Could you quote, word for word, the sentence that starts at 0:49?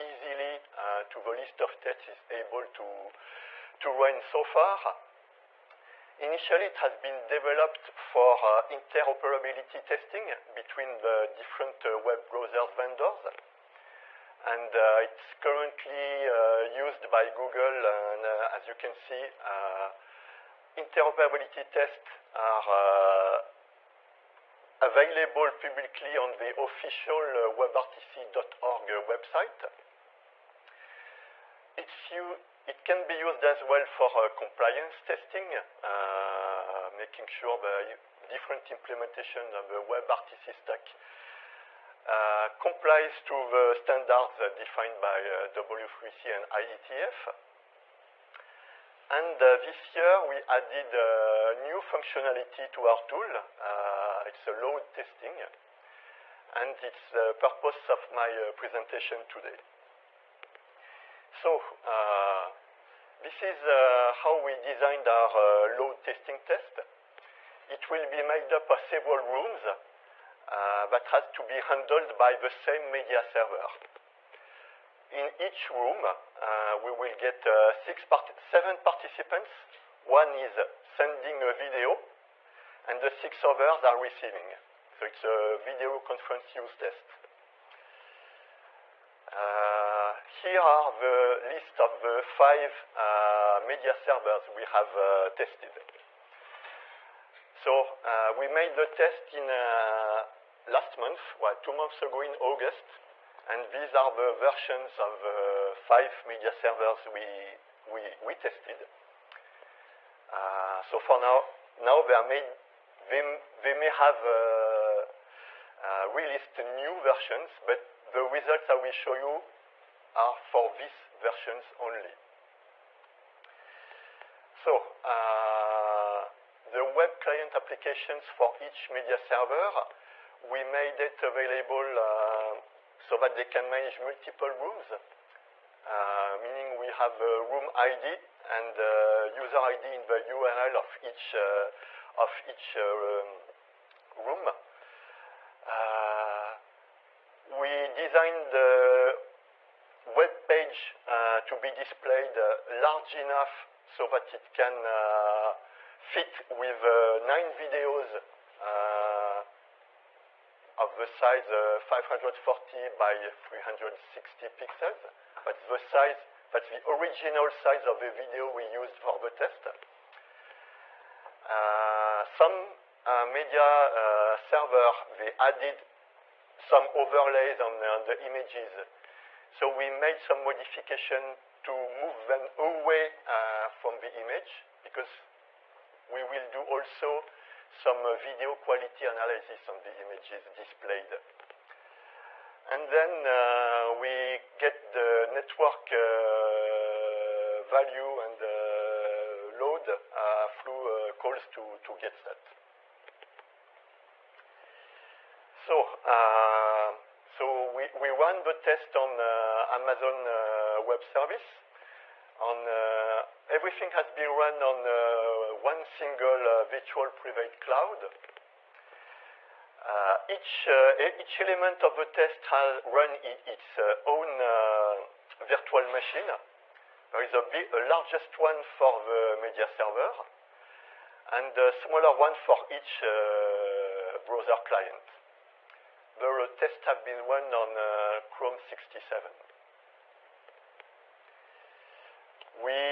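And uh, this year we added new functionality to our tool.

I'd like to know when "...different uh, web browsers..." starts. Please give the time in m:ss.
0:11.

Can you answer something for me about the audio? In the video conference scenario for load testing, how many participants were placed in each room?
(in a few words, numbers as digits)
7.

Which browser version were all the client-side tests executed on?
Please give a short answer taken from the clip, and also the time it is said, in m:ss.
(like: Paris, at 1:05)
Chrome 67, at 3:58.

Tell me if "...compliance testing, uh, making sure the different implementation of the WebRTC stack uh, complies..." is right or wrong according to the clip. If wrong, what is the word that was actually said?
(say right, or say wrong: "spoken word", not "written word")
right.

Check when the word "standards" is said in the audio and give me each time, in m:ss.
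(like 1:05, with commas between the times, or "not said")
0:43.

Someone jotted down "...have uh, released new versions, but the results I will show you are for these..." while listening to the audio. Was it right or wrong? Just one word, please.
right.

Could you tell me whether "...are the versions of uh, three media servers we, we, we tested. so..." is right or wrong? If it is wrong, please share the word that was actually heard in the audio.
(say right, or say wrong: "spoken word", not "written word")
wrong: "five", not "three".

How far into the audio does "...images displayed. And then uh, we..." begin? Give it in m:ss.
3:10.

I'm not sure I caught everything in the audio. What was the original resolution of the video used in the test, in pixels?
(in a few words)
540 by 360.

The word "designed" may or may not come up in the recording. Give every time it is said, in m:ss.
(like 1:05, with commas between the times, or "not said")
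1:04, 2:27.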